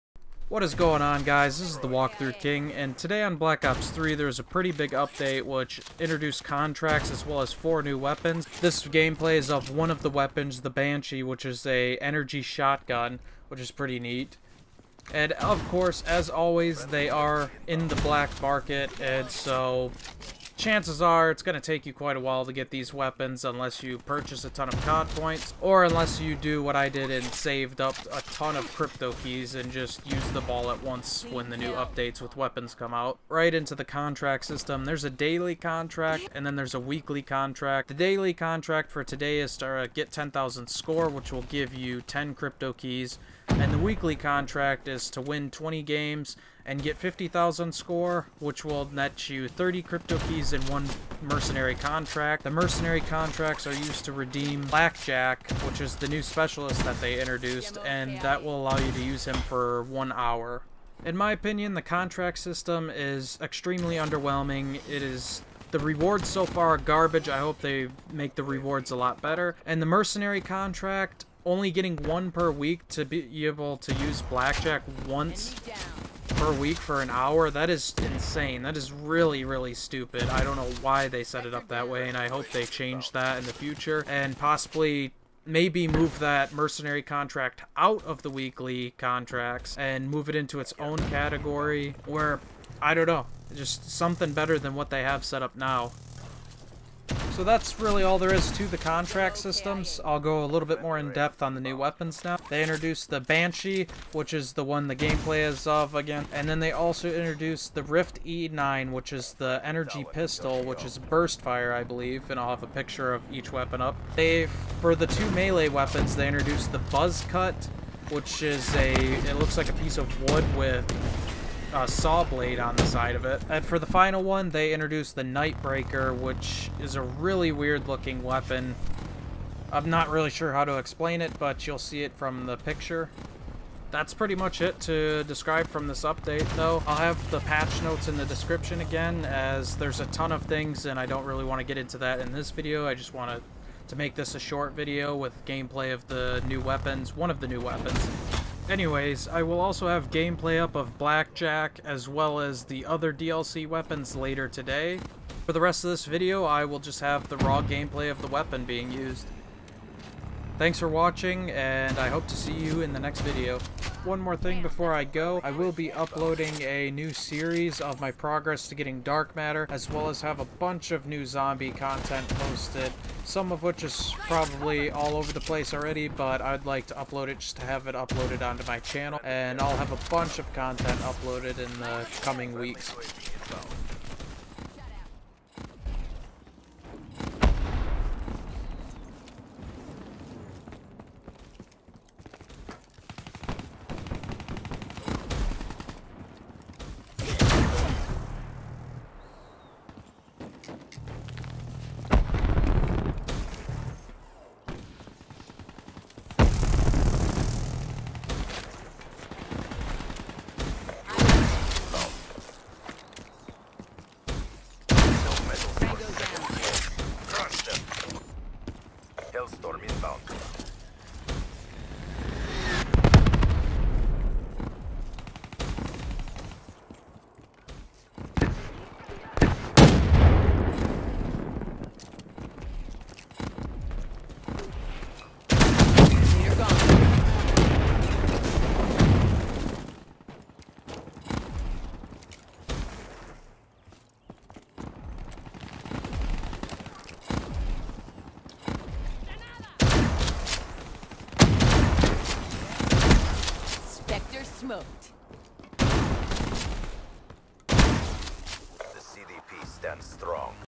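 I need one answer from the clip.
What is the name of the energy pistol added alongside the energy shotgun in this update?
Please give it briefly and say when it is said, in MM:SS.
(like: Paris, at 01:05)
Rift E9, at 01:47.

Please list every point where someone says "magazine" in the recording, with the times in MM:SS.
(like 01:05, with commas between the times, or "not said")
not said.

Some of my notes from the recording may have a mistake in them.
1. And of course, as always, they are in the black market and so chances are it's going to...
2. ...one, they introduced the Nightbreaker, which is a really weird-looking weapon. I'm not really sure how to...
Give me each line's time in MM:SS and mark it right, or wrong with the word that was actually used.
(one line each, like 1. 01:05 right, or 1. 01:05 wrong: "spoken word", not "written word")
1. 00:15 right
2. 02:04 right.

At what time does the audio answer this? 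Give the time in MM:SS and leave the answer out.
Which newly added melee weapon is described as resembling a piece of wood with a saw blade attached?
01:56.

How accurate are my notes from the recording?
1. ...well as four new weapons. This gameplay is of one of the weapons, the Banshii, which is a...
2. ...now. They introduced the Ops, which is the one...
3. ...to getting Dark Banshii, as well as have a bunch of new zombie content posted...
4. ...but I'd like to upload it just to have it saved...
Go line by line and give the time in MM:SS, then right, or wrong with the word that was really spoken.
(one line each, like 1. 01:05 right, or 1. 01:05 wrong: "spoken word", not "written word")
1. 00:07 right
2. 01:42 wrong: "Banshii", not "Ops"
3. 02:48 wrong: "Matter", not "Banshii"
4. 02:56 wrong: "uploaded", not "saved".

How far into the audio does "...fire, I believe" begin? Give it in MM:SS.
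01:51.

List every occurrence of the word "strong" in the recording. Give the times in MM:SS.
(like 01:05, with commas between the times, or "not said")
04:20.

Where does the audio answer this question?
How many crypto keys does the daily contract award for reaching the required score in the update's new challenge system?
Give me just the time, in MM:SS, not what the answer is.
00:42.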